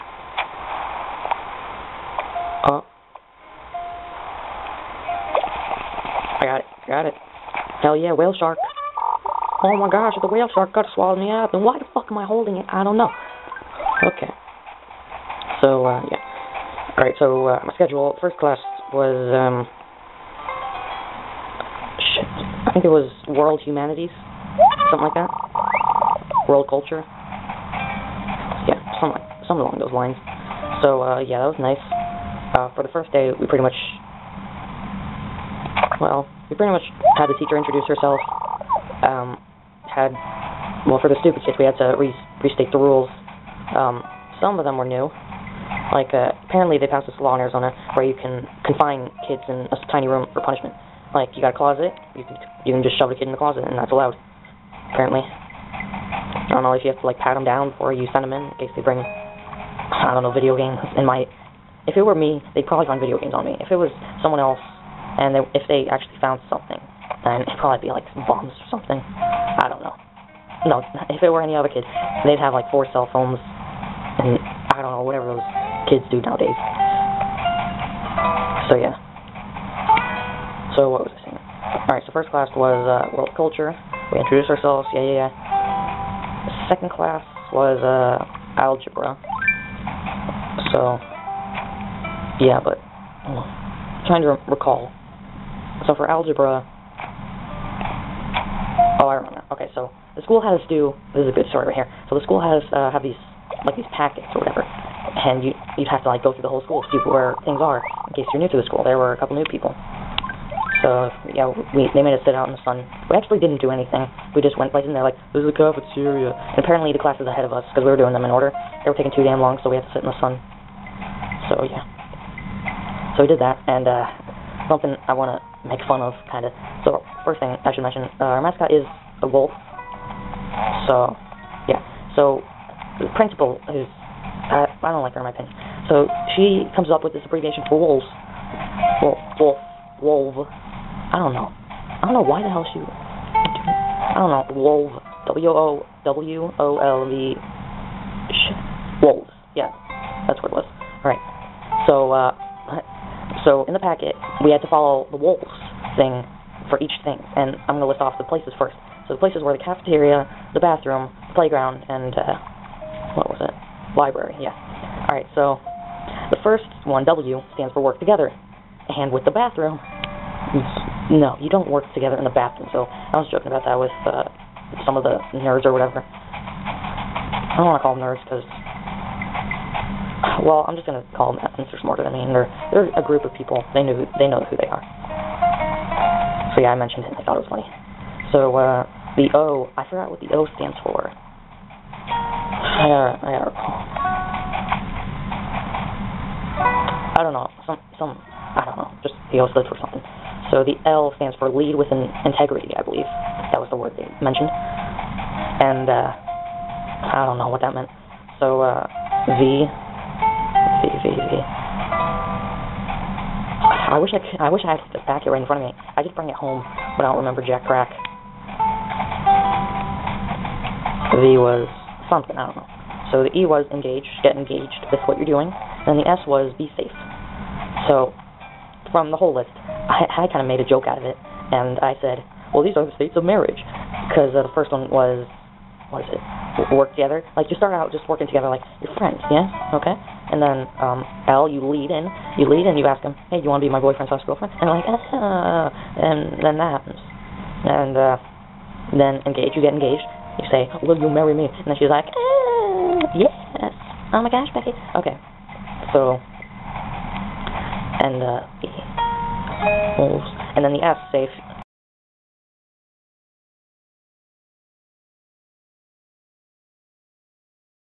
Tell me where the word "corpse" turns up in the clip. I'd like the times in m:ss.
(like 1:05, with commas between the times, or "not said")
not said.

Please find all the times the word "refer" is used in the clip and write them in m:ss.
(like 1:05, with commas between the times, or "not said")
not said.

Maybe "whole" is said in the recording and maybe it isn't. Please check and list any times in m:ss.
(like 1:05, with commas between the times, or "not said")
1:46, 3:49.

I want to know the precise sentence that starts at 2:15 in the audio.
So, she comes up with this abbreviation for wolves.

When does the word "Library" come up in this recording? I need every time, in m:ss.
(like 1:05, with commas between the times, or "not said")
2:43.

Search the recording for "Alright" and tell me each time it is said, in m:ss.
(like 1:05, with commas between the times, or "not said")
0:16, 1:21.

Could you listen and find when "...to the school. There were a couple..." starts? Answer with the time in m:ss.
1:48.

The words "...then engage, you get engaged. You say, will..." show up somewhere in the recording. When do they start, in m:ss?
4:08.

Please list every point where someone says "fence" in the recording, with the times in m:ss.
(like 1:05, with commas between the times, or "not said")
not said.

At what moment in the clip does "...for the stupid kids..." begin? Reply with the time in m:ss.
0:40.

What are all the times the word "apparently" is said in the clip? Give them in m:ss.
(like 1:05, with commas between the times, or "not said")
0:46, 0:54, 1:56.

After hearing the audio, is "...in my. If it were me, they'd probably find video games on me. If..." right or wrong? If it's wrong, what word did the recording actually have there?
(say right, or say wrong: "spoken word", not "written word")
right.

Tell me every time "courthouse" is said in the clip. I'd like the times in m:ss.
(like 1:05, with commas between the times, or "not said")
not said.